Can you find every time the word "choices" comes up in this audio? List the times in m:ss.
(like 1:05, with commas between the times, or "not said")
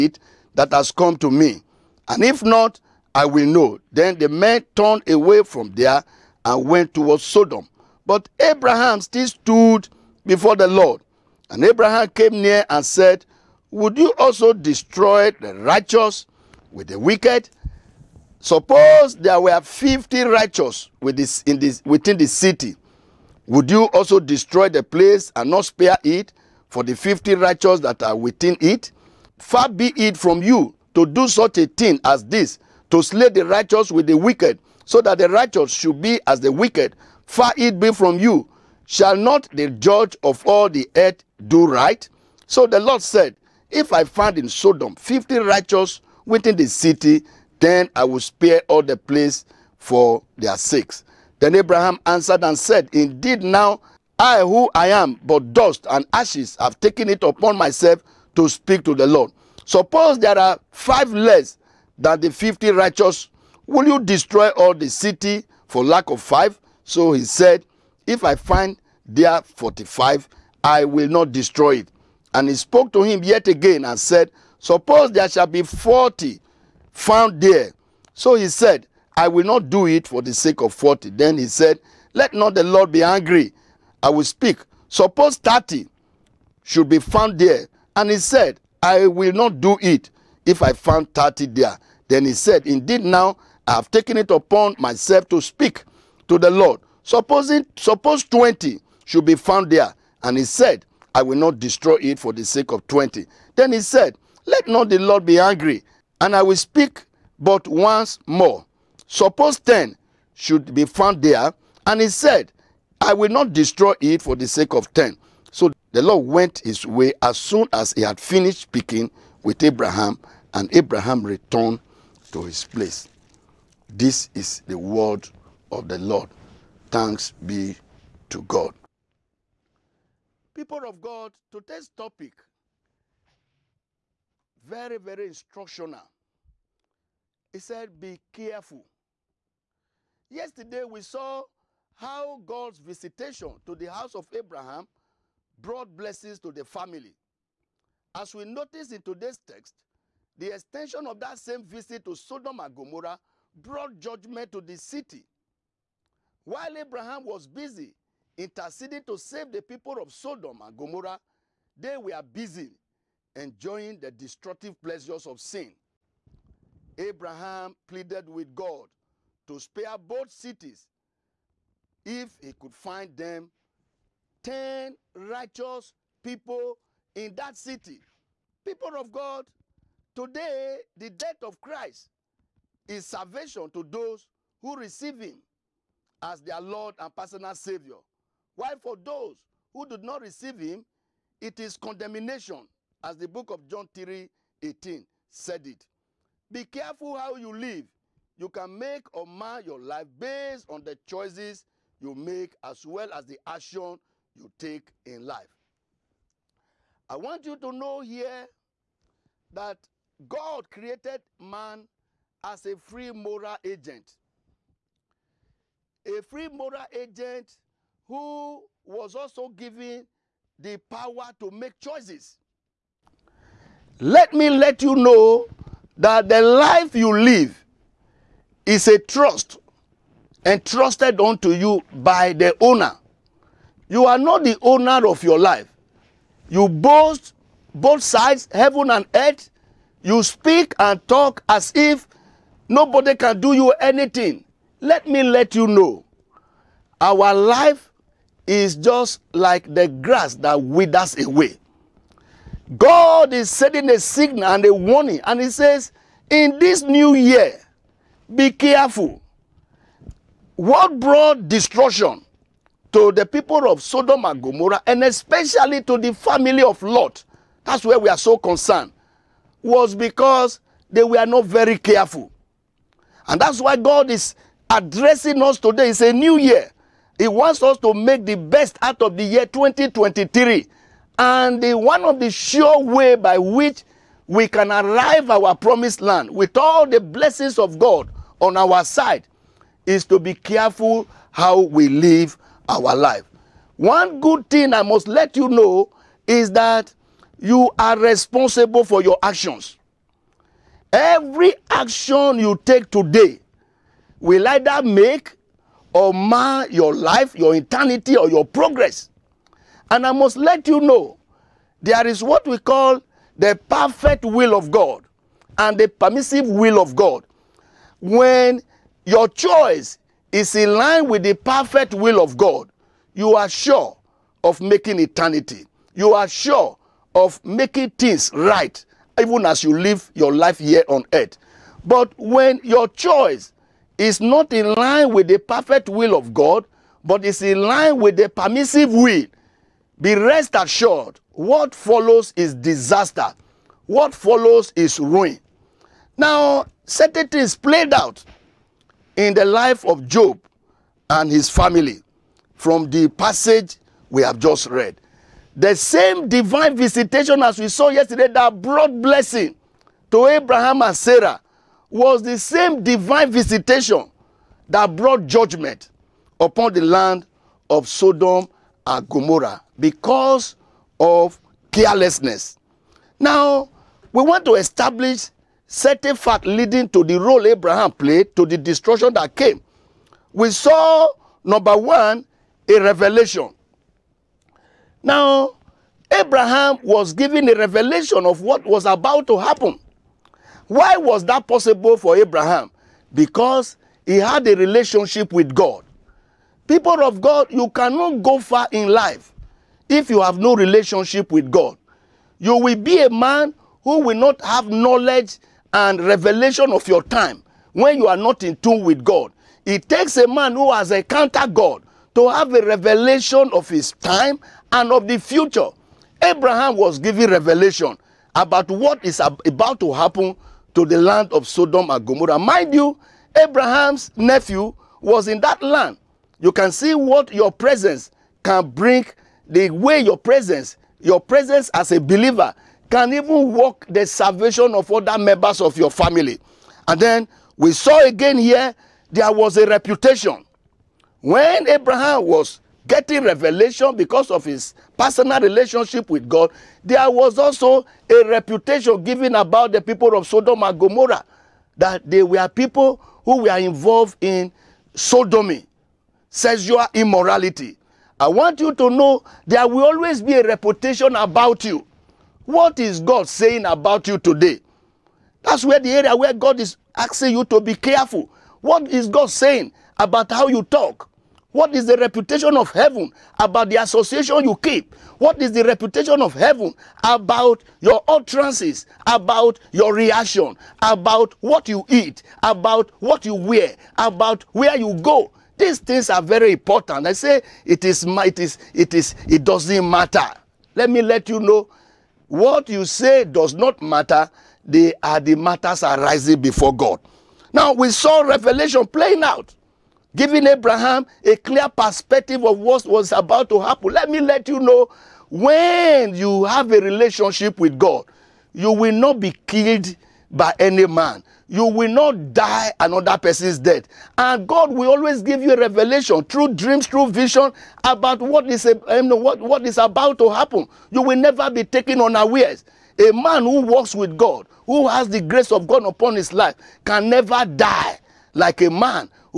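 3:20, 3:41, 5:19, 5:32.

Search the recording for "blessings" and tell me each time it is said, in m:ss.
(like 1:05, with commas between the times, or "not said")
2:25, 4:46, 5:59.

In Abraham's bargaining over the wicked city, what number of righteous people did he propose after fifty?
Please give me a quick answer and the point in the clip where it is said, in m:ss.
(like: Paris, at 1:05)
45, at 1:09.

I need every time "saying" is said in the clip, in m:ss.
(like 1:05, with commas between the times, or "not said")
7:43, 7:49.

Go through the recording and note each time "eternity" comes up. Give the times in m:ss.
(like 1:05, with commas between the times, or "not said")
5:07, 5:24.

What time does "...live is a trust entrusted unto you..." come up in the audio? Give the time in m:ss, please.
3:47.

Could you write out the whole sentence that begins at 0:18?
Suppose there were 50 righteous with this, in this, within the city.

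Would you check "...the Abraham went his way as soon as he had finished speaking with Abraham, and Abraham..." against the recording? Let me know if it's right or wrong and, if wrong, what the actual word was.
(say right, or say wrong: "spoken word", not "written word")
wrong: "Lord", not "Abraham".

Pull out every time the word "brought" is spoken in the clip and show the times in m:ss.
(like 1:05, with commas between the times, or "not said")
2:25, 2:33, 4:20, 5:58, 6:04.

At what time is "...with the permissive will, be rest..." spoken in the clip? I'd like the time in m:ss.
5:37.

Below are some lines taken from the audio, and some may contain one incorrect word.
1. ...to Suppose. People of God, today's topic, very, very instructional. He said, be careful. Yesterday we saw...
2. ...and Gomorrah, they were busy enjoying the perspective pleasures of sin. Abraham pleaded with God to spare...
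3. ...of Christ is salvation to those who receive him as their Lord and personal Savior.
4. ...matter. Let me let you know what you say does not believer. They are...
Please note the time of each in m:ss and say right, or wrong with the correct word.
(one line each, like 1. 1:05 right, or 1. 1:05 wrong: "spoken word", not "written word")
1. 2:08 wrong: "God", not "Suppose"
2. 2:40 wrong: "destructive", not "perspective"
3. 3:01 right
4. 8:09 wrong: "matter", not "believer".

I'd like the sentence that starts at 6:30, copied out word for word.
Why was that possible for Abraham?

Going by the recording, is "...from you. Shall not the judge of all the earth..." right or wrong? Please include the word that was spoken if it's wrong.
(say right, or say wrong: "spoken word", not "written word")
right.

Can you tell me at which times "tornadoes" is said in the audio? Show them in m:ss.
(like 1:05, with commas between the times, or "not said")
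not said.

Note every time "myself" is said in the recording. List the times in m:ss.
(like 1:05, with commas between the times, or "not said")
0:57, 1:34.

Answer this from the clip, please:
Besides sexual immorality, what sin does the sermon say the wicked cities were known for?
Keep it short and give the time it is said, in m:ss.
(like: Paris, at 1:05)
sodomy, at 7:34.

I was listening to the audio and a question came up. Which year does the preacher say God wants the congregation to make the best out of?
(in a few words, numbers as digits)
2023.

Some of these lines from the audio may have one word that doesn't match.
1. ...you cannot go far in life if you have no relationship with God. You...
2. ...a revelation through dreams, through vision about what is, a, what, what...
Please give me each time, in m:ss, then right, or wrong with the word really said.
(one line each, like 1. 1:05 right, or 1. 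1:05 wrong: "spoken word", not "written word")
1. 6:37 right
2. 8:35 right.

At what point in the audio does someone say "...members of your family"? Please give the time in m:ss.
7:15.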